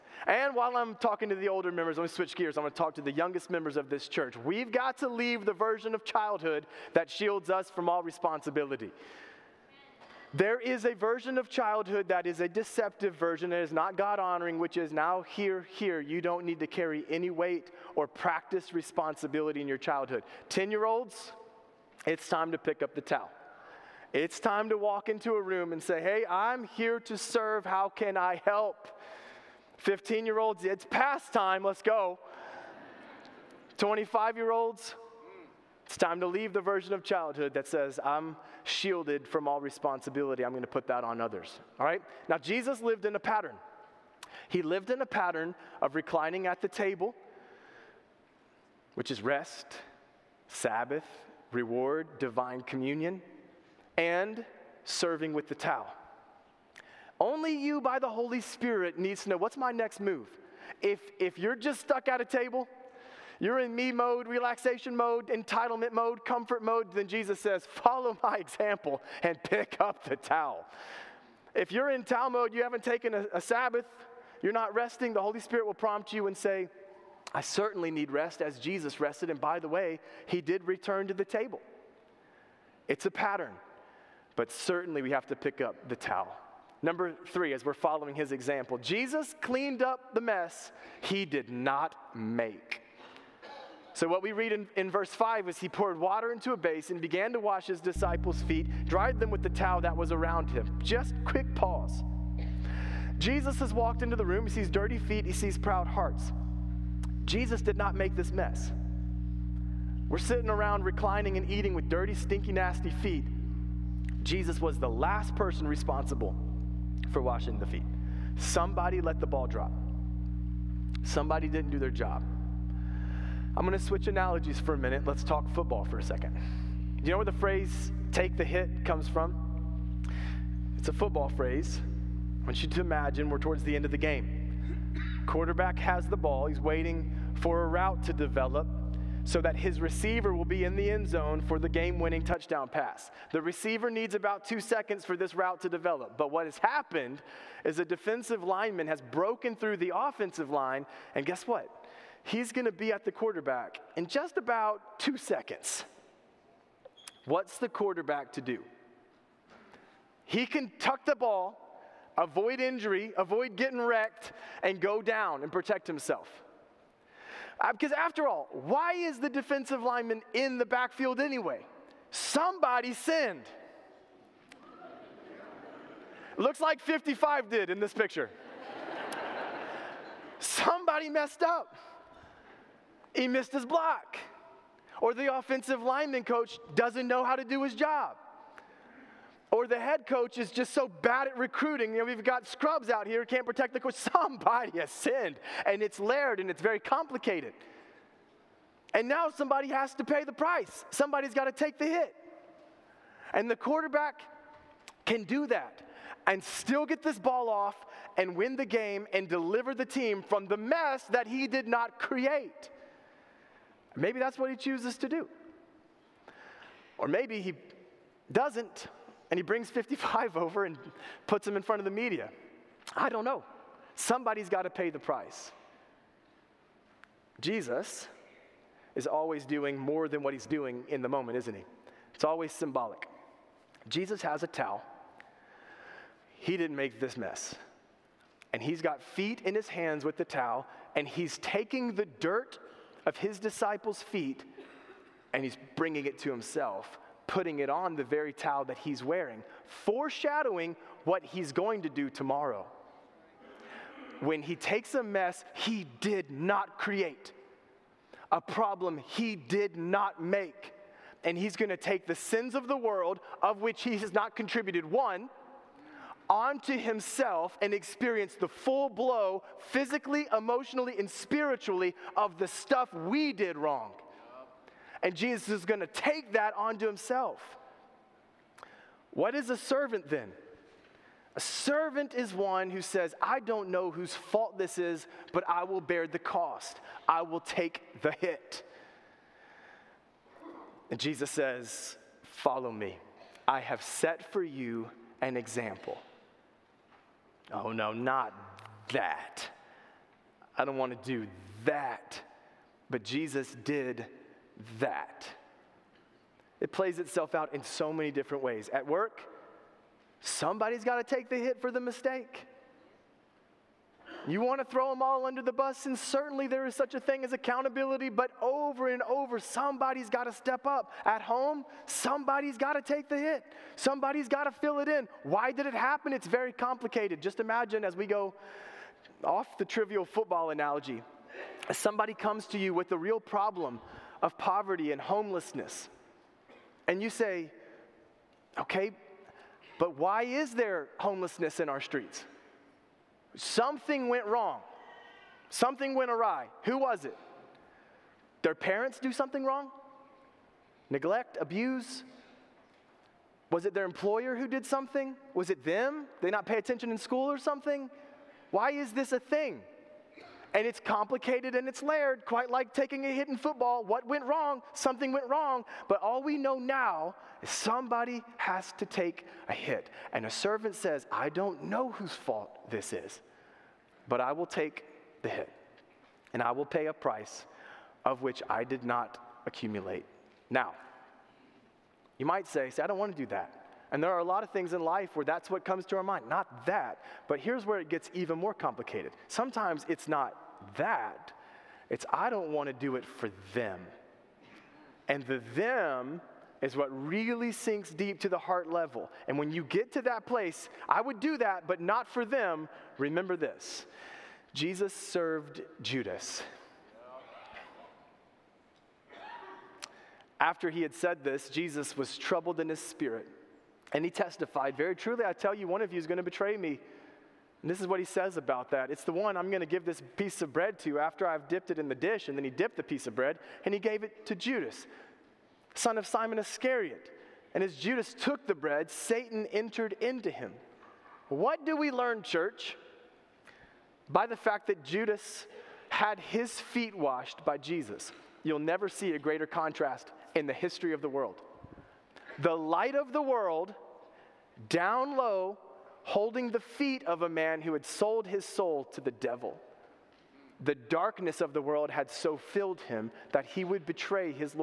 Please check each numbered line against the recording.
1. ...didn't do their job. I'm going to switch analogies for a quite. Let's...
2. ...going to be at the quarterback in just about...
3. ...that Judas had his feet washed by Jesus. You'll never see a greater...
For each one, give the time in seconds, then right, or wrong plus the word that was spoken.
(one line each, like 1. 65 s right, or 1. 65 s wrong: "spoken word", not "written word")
1. 121 s wrong: "minute", not "quite"
2. 152 s right
3. 434 s right.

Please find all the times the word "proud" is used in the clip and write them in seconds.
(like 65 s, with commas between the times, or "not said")
105 s.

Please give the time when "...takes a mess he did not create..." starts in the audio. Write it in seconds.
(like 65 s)
254 s.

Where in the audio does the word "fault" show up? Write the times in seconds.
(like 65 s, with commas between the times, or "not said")
284 s, 372 s.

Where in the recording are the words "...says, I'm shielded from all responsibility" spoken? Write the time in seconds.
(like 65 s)
37 s.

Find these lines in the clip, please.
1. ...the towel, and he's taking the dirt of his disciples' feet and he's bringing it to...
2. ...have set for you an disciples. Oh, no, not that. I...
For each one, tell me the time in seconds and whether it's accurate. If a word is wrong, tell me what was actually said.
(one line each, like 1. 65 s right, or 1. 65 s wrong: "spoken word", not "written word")
1. 240 s right
2. 293 s wrong: "example", not "disciples".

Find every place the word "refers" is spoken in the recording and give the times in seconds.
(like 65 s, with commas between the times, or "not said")
not said.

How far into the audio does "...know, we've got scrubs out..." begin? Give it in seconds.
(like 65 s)
191 s.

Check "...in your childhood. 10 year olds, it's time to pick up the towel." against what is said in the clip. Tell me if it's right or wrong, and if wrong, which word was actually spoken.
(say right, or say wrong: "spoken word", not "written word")
right.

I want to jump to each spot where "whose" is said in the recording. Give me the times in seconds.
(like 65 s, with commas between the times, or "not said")
283 s, 371 s.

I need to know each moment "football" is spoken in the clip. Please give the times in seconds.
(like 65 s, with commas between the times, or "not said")
125 s, 130 s, 330 s, 363 s.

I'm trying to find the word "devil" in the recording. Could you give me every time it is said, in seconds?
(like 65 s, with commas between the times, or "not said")
449 s.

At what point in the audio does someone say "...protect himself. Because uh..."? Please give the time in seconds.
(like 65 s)
165 s.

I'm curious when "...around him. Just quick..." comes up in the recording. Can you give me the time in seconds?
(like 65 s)
100 s.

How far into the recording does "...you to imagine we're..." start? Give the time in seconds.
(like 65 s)
132 s.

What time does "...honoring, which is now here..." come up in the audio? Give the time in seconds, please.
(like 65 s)
14 s.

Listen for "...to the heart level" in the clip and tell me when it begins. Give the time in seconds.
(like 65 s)
398 s.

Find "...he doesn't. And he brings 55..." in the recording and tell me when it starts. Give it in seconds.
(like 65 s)
217 s.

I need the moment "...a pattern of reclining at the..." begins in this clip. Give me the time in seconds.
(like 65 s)
44 s.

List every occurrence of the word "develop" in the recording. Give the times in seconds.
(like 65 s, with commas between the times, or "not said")
138 s, 145 s.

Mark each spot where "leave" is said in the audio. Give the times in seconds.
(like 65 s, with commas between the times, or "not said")
5 s, 36 s.